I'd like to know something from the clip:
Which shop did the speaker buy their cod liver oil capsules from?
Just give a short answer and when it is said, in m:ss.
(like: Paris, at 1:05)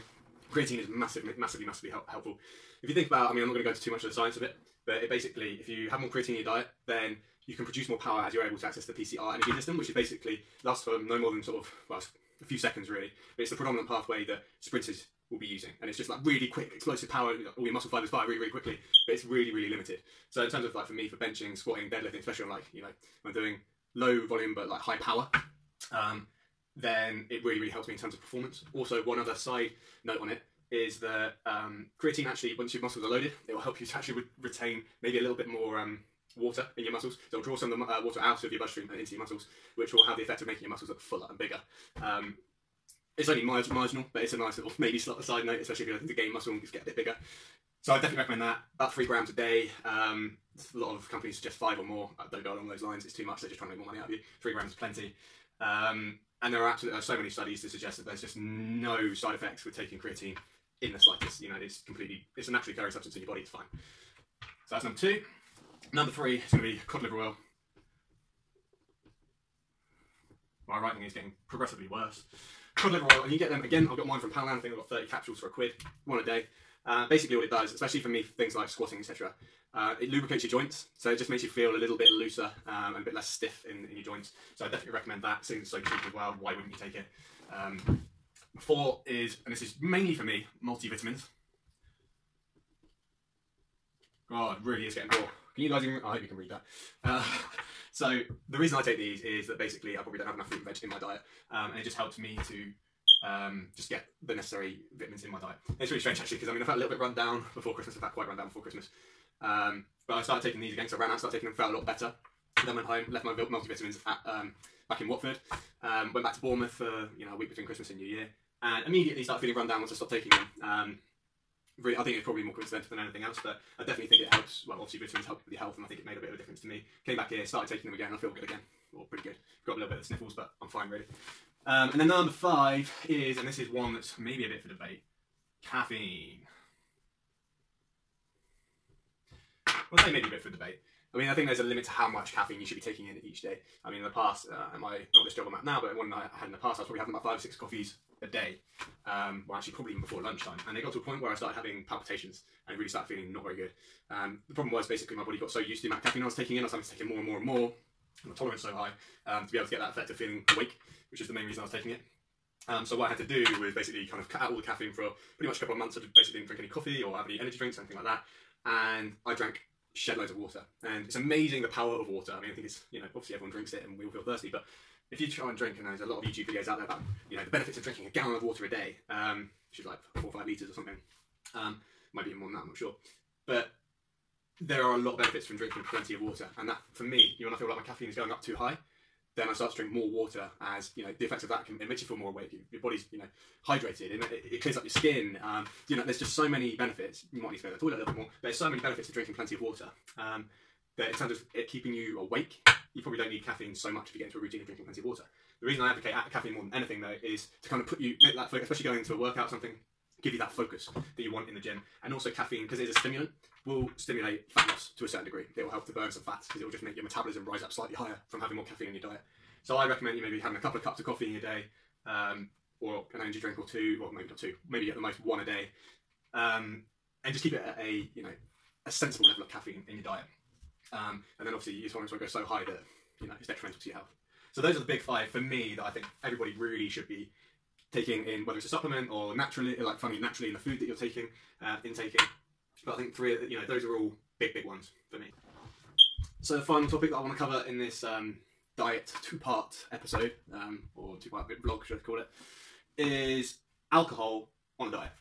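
Poundland, at 1:14.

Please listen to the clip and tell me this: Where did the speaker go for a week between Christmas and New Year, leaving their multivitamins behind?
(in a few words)
Bournemouth.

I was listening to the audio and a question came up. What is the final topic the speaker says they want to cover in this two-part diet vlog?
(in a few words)
Alcohol.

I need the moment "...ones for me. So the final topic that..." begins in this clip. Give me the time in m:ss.
4:04.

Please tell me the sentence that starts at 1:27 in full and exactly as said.
Um, four is, and this is mainly for me, multivitamins.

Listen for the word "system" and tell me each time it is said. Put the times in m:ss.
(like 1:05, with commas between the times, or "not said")
0:09.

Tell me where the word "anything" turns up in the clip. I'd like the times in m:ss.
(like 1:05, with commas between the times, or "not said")
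2:02, 2:47, 3:26.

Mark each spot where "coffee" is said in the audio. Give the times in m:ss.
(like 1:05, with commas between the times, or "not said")
2:27, 2:46, 3:41.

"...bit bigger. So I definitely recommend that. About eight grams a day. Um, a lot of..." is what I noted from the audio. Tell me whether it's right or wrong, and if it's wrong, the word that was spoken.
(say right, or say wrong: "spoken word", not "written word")
wrong: "three", not "eight".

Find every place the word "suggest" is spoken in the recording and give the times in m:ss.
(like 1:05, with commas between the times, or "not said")
0:51, 0:57.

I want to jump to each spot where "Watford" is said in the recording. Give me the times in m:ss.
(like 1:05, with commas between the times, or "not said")
1:55.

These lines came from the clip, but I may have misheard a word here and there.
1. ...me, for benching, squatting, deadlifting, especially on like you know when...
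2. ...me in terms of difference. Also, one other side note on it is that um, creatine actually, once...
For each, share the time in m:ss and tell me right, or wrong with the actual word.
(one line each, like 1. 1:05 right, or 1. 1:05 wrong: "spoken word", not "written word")
1. 0:20 right
2. 0:27 wrong: "performance", not "difference".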